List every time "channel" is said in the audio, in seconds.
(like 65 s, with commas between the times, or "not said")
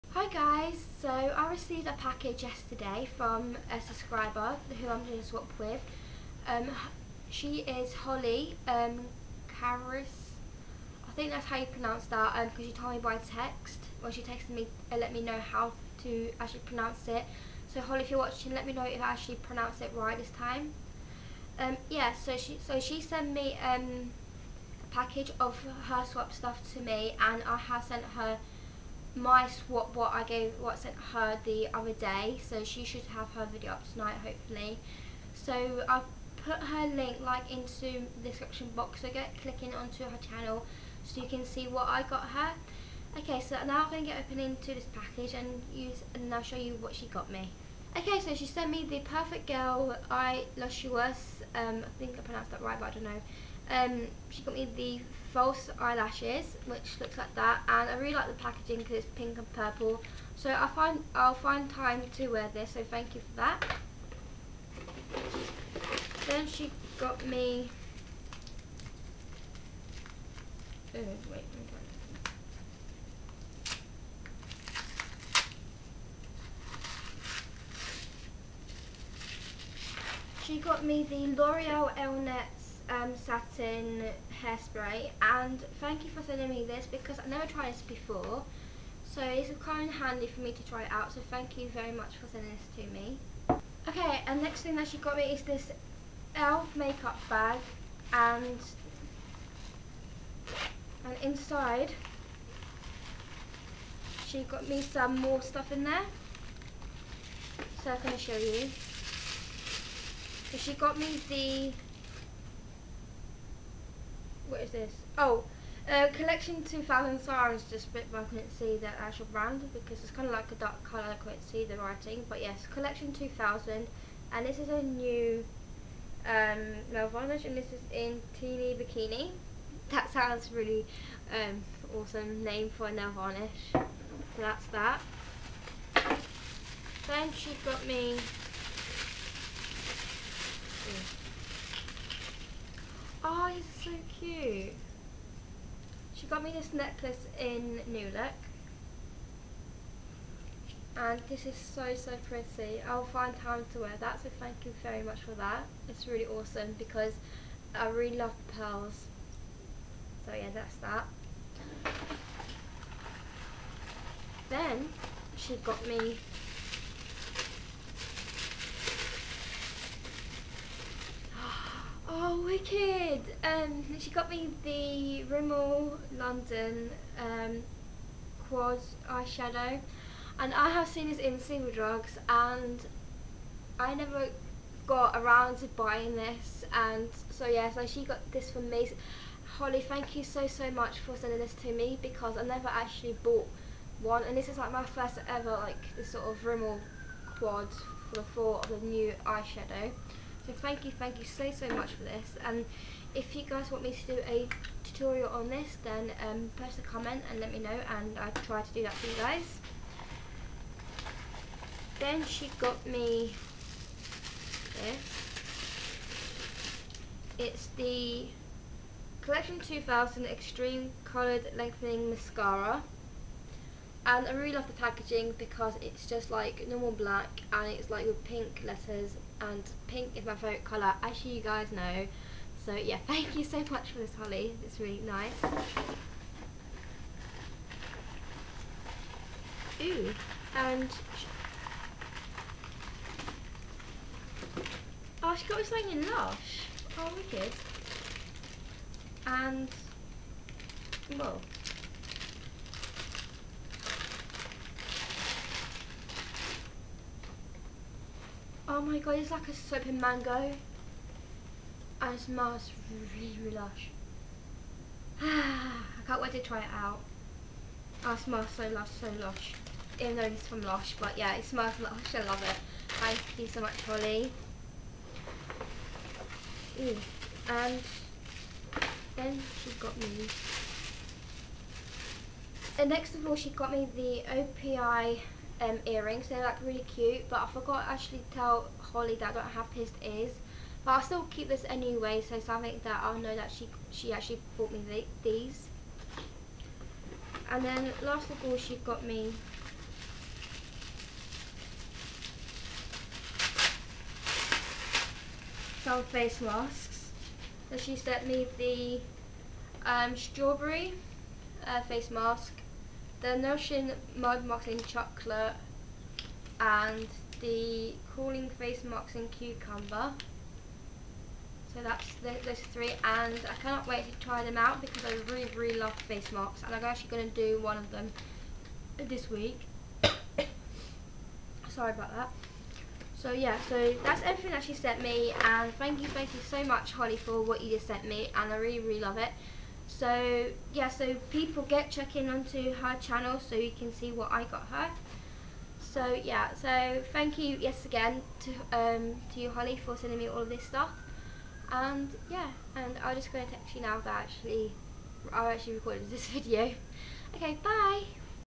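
40 s, 342 s.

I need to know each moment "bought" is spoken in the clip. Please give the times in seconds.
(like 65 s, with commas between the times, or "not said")
193 s, 294 s.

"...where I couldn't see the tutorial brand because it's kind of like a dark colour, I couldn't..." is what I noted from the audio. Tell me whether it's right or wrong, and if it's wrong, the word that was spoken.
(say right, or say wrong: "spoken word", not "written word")
wrong: "actual", not "tutorial".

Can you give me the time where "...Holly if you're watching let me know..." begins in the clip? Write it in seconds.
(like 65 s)
17 s.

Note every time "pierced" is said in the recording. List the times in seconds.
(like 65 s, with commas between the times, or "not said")
289 s.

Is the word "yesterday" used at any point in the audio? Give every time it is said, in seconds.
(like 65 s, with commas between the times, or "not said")
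2 s.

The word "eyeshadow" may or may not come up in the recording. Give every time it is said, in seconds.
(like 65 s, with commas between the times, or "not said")
179 s, 199 s.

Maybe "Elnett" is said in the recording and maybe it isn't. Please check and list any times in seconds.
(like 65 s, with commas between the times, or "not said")
81 s.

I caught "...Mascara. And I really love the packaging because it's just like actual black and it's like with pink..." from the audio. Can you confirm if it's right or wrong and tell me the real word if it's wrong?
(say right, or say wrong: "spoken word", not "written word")
wrong: "normal", not "actual".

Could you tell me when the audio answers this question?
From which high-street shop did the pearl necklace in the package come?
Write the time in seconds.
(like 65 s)
147 s.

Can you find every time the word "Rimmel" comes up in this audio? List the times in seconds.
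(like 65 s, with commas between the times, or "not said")
175 s, 196 s.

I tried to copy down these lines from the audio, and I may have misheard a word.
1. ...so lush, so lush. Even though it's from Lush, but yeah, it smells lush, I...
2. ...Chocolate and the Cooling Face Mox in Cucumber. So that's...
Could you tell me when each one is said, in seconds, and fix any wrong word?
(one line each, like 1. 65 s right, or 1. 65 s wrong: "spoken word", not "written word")
1. 268 s right
2. 314 s right.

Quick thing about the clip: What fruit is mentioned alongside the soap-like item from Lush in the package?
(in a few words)
Mango.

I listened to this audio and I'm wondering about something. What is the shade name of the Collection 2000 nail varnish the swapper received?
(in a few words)
Teeny Bikini.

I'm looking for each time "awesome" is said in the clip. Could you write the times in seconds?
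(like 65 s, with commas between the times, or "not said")
131 s, 156 s.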